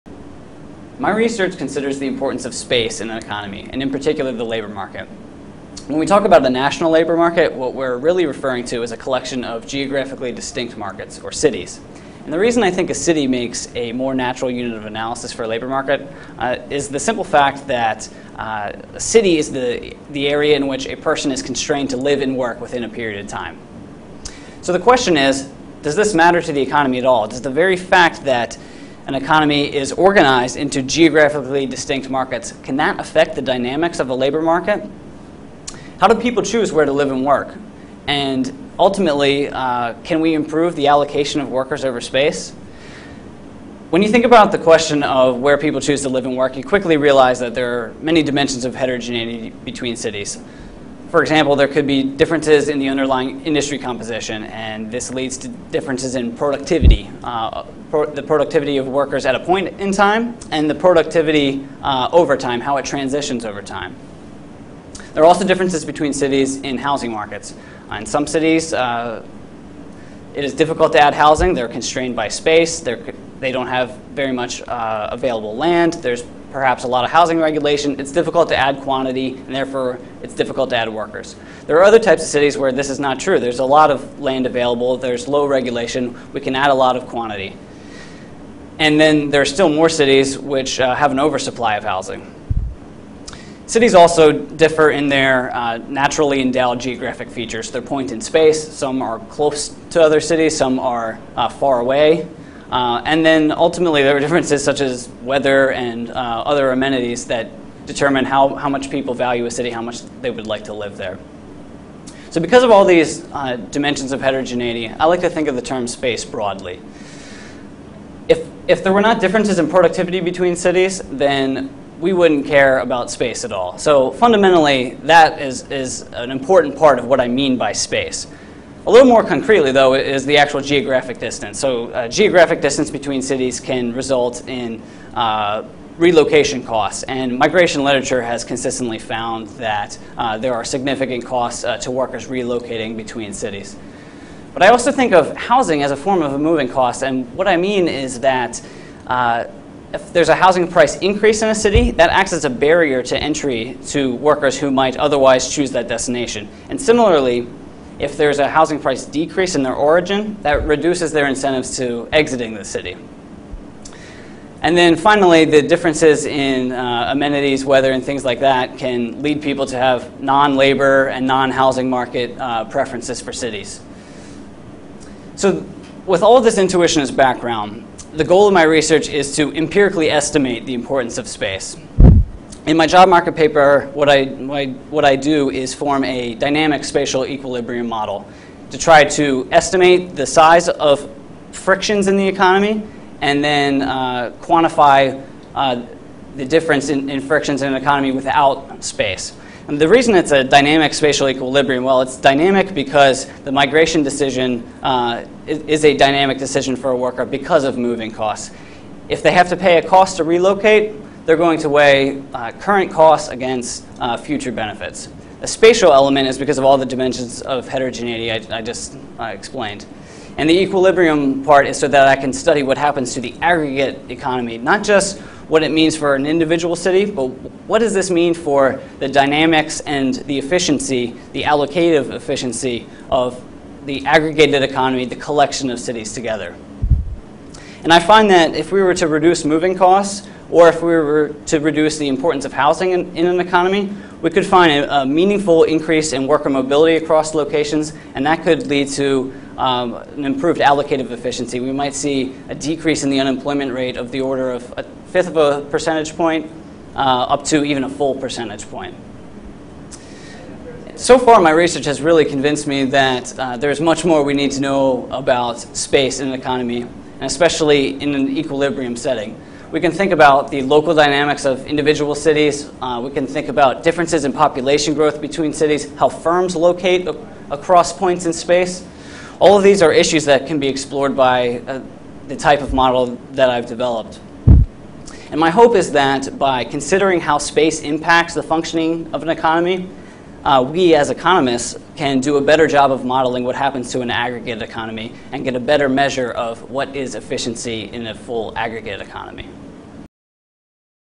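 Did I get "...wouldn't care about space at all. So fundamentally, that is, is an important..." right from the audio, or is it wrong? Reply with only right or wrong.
right.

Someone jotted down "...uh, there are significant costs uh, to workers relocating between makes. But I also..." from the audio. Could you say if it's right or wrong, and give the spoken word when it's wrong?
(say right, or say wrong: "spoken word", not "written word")
wrong: "cities", not "makes".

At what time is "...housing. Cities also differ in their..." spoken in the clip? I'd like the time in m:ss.
1:31.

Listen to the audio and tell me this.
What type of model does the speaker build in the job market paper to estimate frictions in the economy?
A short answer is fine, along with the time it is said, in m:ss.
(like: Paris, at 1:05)
dynamic spatial equilibrium model, at 3:06.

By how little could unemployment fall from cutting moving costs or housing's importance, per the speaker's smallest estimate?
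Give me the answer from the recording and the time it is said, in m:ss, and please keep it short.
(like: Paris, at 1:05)
a fifth of a percentage point, at 4:14.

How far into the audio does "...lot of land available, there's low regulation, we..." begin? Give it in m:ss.
1:23.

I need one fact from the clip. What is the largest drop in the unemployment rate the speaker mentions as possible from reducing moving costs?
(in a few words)
1 percentage point.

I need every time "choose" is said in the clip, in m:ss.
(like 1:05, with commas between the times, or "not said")
0:36, 0:45, 2:35.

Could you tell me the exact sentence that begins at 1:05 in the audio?
There are also differences between cities in housing markets.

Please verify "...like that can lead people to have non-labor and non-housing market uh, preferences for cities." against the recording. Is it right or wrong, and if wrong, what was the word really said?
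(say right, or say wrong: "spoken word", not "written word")
right.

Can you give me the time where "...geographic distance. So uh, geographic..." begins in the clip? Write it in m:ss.
2:10.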